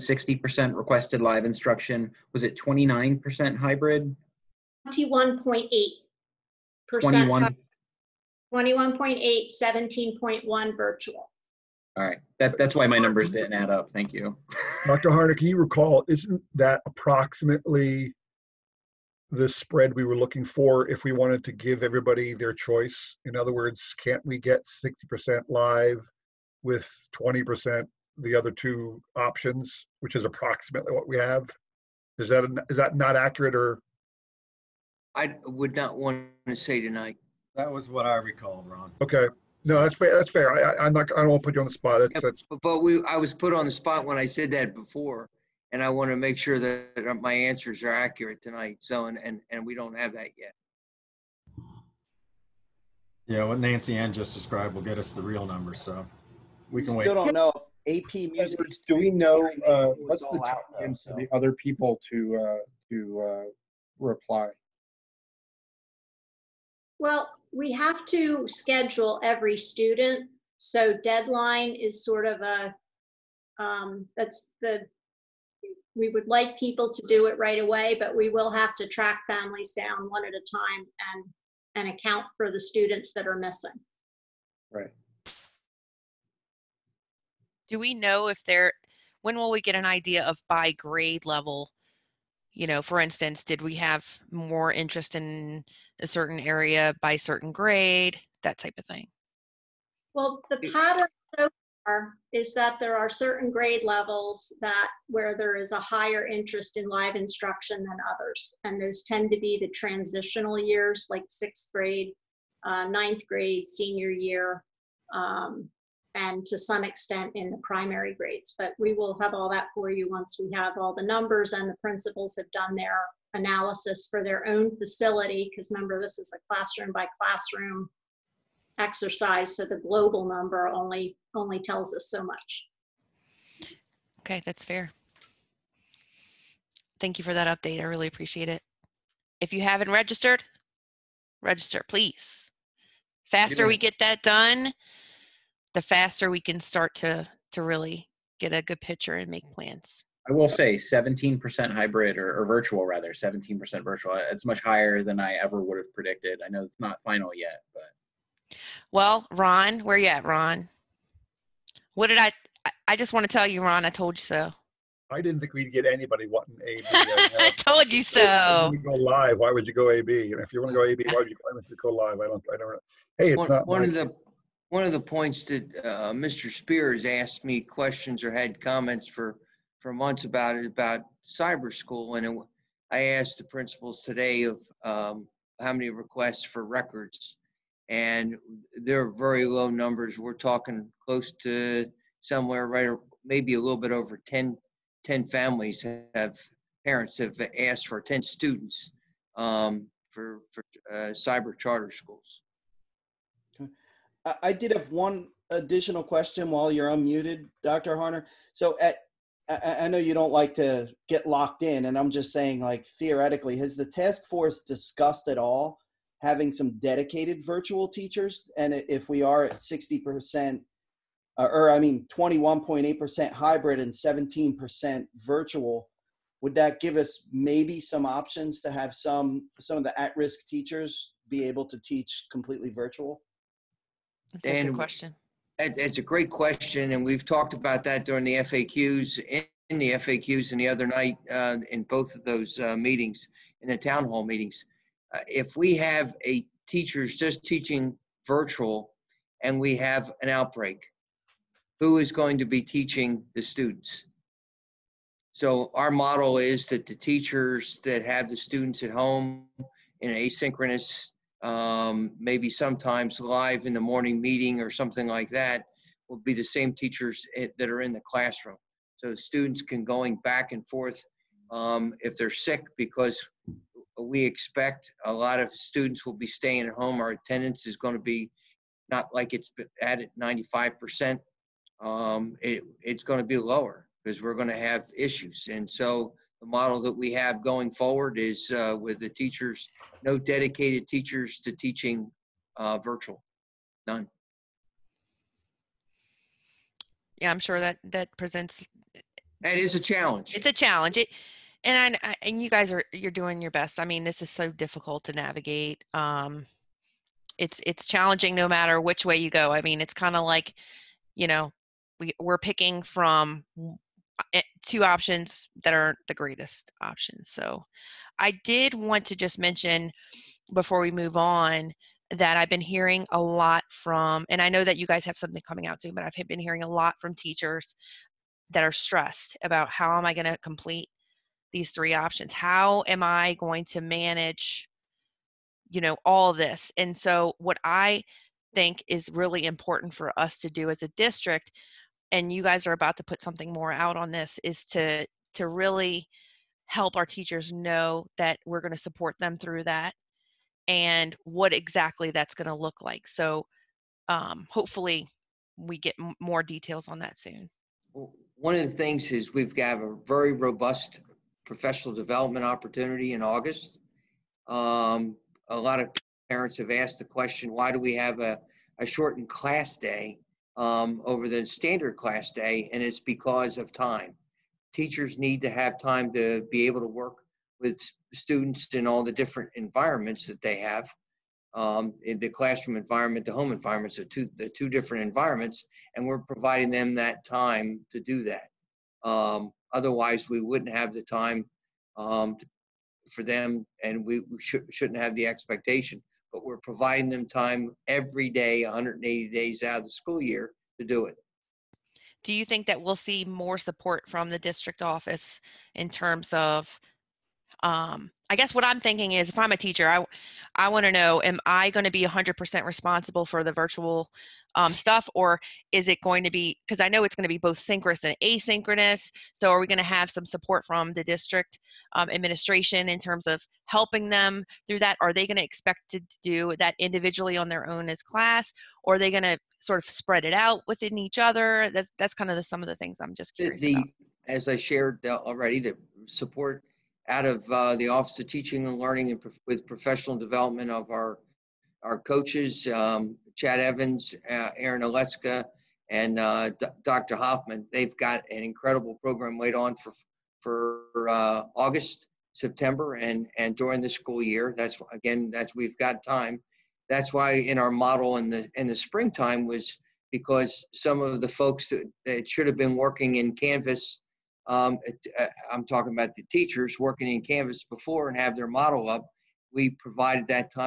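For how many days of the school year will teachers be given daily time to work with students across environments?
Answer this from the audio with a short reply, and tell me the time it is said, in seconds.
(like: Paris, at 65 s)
180, at 398 s.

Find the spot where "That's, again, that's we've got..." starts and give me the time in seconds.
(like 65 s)
454 s.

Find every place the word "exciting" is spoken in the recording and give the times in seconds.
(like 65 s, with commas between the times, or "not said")
not said.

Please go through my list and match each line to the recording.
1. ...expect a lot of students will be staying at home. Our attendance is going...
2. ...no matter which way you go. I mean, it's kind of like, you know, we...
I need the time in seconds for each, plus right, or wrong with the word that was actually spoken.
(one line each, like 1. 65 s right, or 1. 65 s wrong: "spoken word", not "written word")
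1. 274 s right
2. 308 s right.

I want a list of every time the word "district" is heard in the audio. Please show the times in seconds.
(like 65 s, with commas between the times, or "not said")
340 s, 404 s, 421 s.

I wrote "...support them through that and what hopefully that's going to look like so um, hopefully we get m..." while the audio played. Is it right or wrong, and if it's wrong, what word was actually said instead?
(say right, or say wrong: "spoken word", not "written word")
wrong: "exactly", not "hopefully".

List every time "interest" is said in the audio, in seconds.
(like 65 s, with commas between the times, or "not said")
94 s, 106 s.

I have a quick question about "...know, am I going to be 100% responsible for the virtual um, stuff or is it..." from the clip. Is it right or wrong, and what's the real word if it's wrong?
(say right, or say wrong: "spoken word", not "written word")
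right.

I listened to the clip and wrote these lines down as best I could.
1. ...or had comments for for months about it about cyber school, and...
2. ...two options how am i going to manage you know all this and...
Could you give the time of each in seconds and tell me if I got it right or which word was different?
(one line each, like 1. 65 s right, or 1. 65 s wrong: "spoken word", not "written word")
1. 178 s right
2. 331 s wrong: "three", not "two".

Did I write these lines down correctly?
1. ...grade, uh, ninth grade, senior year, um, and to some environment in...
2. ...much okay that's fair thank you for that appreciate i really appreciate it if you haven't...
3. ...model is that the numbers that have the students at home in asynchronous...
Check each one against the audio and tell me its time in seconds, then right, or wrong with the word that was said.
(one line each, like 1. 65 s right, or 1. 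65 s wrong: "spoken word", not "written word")
1. 111 s wrong: "extent", not "environment"
2. 132 s wrong: "update", not "appreciate"
3. 255 s wrong: "teachers", not "numbers".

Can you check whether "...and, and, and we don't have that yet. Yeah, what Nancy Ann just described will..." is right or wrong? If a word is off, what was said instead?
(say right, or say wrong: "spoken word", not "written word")
right.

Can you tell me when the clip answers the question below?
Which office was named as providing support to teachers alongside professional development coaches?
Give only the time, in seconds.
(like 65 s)
437 s.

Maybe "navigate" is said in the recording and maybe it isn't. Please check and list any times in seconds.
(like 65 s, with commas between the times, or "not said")
305 s.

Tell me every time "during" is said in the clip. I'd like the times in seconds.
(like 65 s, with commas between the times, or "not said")
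238 s, 453 s.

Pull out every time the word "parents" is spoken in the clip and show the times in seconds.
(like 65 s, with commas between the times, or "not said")
196 s, 366 s.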